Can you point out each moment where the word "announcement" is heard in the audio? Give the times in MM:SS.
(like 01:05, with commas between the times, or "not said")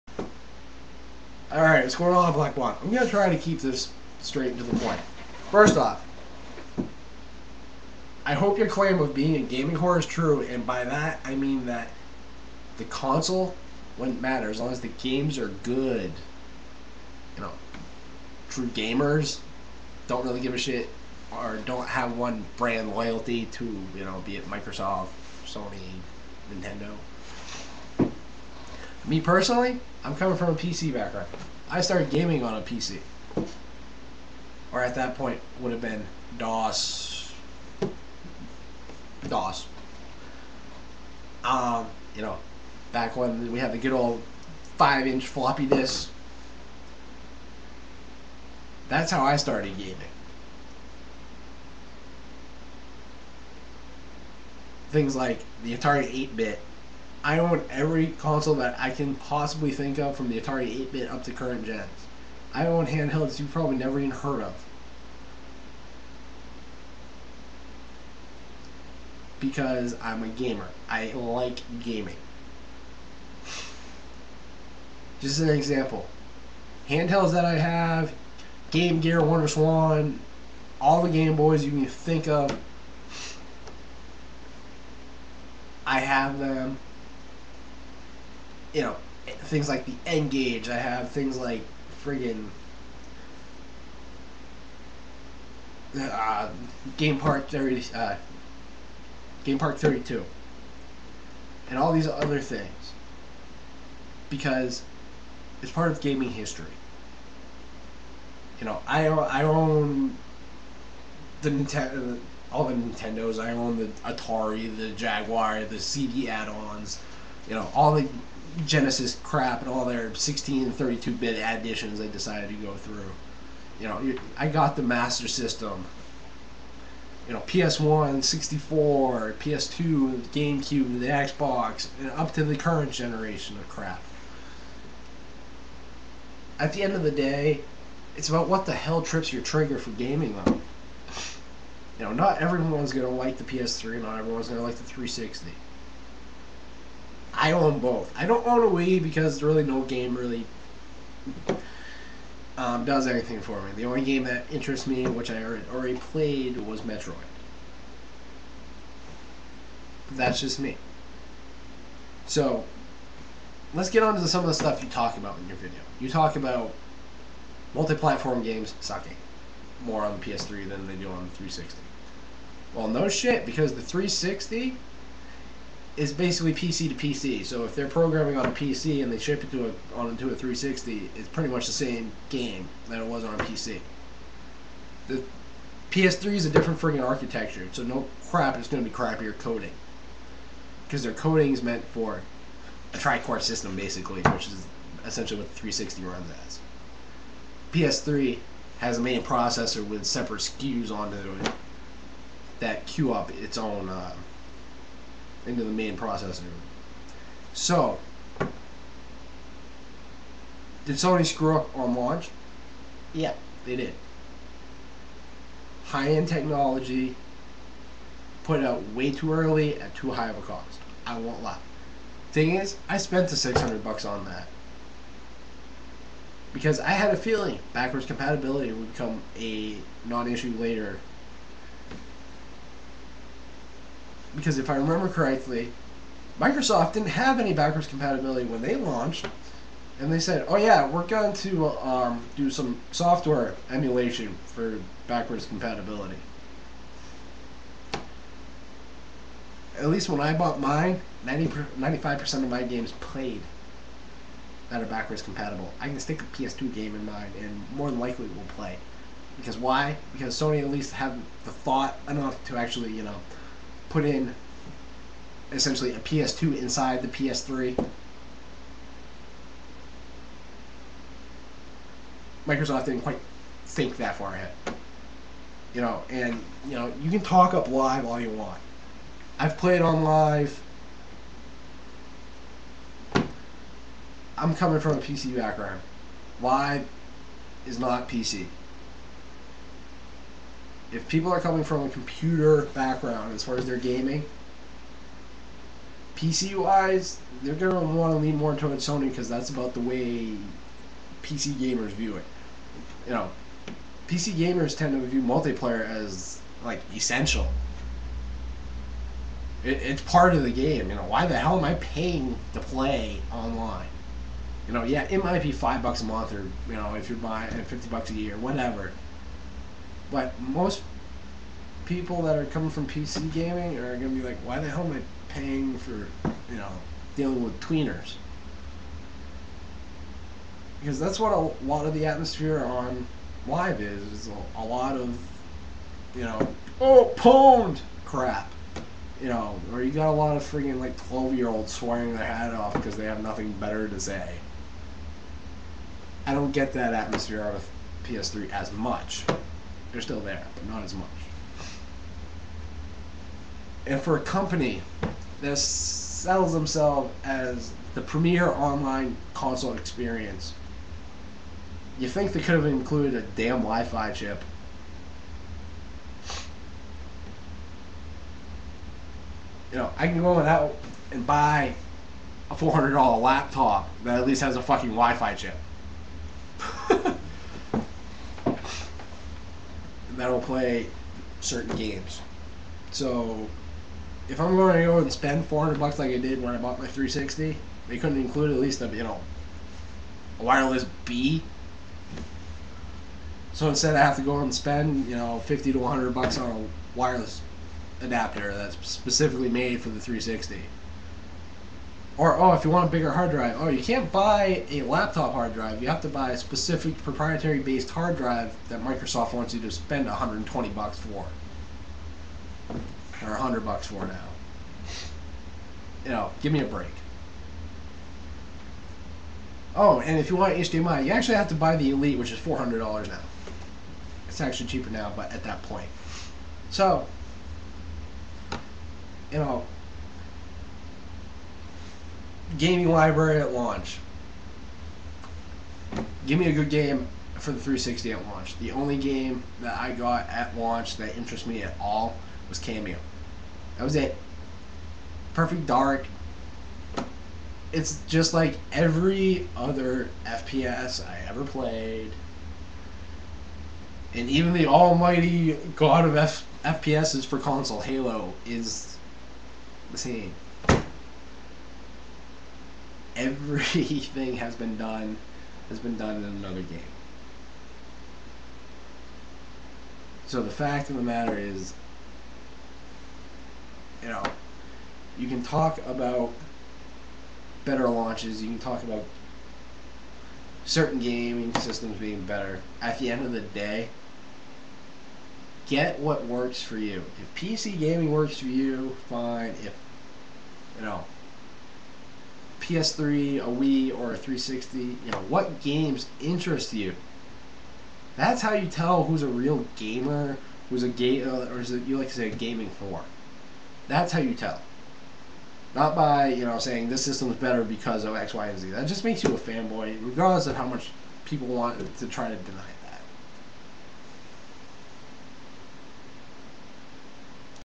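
not said.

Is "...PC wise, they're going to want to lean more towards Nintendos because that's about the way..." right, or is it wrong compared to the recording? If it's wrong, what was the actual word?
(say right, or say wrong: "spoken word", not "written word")
wrong: "Sony", not "Nintendos".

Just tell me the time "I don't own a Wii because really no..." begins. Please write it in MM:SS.
02:28.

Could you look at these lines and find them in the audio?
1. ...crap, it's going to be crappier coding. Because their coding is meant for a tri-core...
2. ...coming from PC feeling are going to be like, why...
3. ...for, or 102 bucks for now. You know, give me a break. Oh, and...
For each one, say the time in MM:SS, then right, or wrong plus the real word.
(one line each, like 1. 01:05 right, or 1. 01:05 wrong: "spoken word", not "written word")
1. 03:08 right
2. 05:22 wrong: "gaming", not "feeling"
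3. 06:50 wrong: "100", not "102".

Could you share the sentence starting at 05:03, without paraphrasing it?
You know, PC gamers tend to view multiplayer as like essential.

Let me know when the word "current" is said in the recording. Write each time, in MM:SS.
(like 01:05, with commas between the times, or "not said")
01:01, 02:12.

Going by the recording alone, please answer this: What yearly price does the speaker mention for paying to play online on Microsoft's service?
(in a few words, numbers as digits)
fifty bucks.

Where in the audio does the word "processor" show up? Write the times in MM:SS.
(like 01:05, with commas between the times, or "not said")
03:19, 03:25.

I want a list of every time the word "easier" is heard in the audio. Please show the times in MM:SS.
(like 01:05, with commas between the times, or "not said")
not said.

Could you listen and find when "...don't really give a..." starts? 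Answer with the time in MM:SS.
00:20.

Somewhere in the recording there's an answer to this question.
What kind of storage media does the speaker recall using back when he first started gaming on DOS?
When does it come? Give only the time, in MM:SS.
00:44.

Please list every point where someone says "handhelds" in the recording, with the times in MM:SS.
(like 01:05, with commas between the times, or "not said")
01:02, 01:16.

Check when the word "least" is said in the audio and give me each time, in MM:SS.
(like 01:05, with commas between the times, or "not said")
04:09, 04:20, 06:14, 06:28.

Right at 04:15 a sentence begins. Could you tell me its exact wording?
I can stick a PS2 game in mine, and more than likely it will play.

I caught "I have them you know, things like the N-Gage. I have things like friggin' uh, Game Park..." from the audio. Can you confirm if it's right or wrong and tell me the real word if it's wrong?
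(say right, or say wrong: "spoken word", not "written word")
right.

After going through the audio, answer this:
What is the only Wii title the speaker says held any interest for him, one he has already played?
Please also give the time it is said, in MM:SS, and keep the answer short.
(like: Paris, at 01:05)
Metroid, at 02:36.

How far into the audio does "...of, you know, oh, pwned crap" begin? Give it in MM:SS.
05:34.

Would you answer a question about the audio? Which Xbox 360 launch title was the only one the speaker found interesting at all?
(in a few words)
Kameo.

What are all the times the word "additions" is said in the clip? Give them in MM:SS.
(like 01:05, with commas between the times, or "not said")
02:01.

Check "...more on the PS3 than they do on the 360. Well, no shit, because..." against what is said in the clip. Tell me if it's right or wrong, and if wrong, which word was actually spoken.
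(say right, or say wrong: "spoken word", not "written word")
right.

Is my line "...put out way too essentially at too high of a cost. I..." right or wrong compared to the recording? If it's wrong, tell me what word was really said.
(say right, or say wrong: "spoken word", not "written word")
wrong: "early", not "essentially".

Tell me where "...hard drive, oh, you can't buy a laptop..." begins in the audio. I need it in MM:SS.
06:43.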